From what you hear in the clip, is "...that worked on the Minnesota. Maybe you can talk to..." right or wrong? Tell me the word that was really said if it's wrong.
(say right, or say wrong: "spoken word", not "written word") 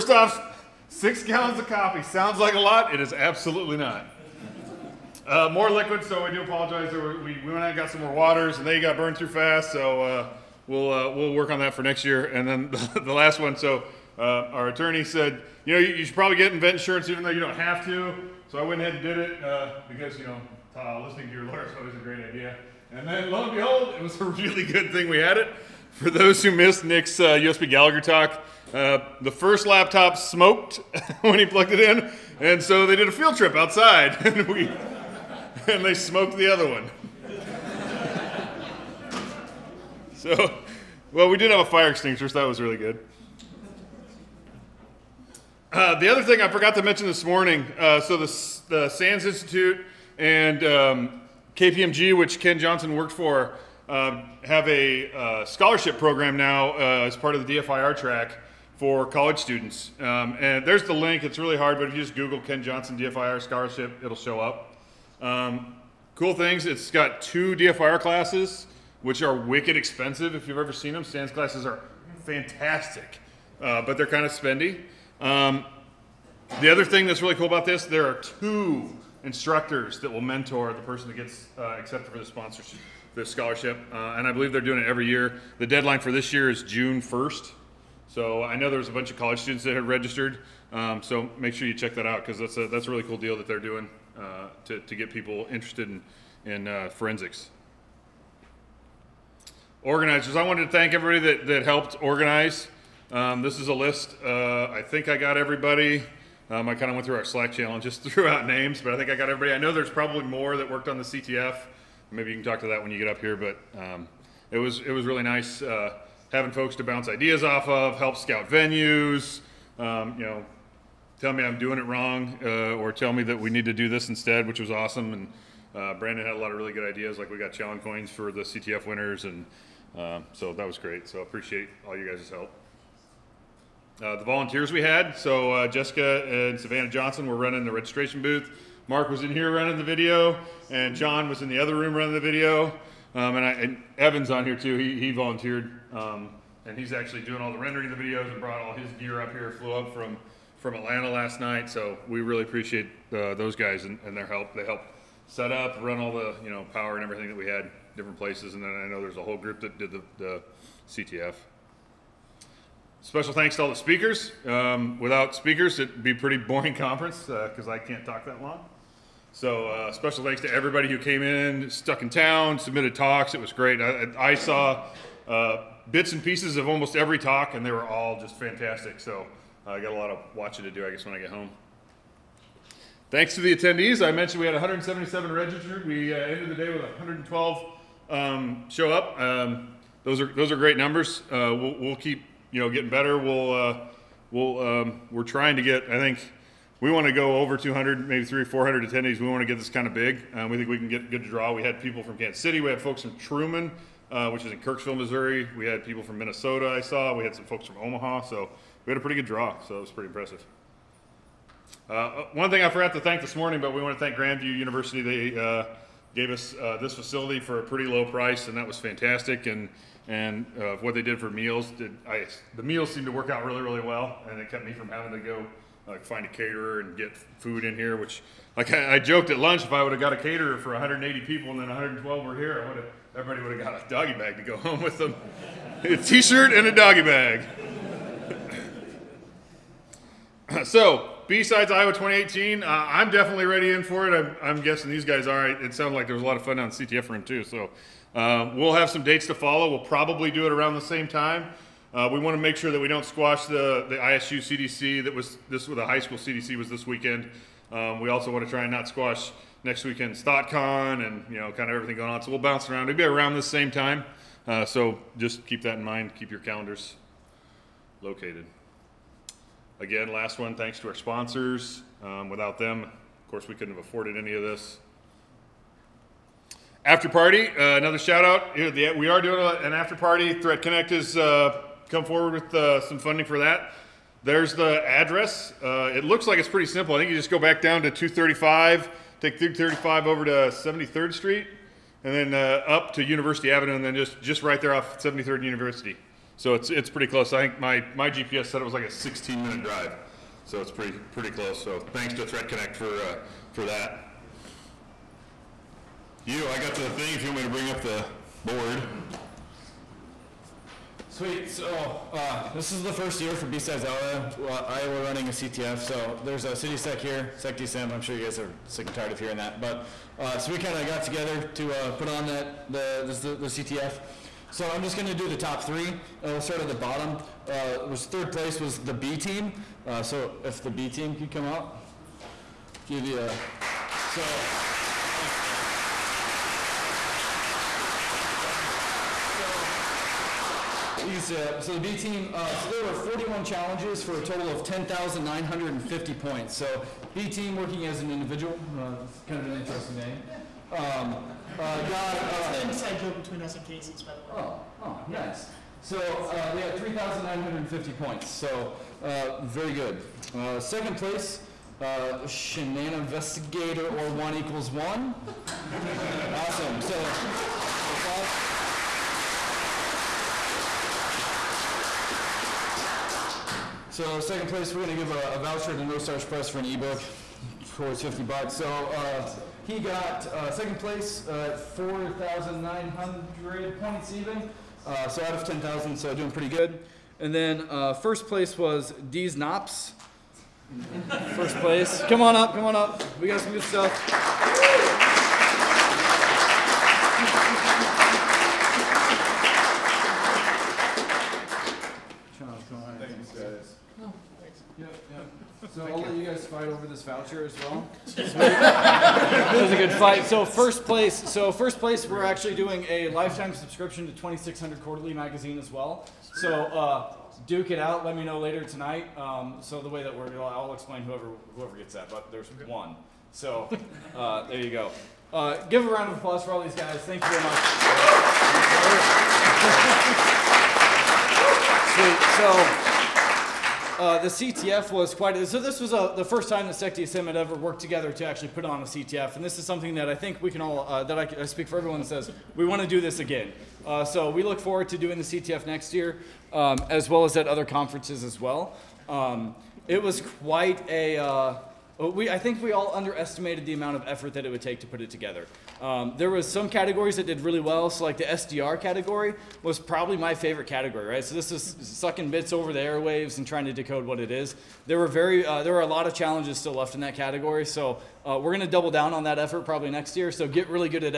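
wrong: "CTF", not "Minnesota".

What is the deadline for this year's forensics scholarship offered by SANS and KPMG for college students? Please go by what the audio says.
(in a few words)
June 1st.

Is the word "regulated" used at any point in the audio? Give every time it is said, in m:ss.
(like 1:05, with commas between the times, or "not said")
not said.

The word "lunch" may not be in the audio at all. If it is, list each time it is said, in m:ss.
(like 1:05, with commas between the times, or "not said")
3:49.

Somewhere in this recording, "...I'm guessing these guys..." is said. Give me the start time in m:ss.
4:04.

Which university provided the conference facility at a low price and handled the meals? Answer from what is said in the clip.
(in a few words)
Grandview University.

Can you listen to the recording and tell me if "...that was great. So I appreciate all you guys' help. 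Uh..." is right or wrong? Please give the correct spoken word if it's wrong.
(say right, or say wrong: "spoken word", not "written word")
right.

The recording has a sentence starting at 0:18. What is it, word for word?
So I went ahead and did it uh, because, you know, listening to your lawyer is always a great idea.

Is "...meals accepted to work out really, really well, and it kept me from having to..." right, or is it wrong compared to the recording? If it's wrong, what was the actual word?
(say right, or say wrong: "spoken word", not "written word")
wrong: "seemed", not "accepted".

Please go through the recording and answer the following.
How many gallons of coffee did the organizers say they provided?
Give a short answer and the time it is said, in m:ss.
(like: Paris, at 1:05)
6, at 0:00.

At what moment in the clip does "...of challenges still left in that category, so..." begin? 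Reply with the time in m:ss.
7:46.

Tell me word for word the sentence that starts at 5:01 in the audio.
So thanks to ThreatConnect for uh, for that.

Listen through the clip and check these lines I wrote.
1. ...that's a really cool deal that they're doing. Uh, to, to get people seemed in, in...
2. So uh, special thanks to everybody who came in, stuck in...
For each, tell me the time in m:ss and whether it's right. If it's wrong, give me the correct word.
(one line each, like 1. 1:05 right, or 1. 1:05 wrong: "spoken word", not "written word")
1. 1:32 wrong: "interested", not "seemed"
2. 2:49 right.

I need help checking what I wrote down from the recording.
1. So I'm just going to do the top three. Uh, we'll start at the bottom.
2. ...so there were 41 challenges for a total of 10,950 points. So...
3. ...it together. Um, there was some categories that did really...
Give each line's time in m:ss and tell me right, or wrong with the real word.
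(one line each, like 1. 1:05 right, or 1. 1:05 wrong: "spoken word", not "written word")
1. 5:24 right
2. 5:42 right
3. 7:34 right.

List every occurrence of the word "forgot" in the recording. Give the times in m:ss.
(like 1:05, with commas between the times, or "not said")
0:46, 3:32.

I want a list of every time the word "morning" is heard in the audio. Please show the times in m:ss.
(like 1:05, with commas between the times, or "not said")
0:47, 3:33.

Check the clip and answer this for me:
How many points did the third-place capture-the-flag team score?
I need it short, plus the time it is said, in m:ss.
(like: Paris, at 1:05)
3,950, at 5:56.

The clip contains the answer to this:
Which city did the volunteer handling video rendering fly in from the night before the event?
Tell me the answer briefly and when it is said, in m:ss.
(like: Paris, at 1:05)
Atlanta, at 2:30.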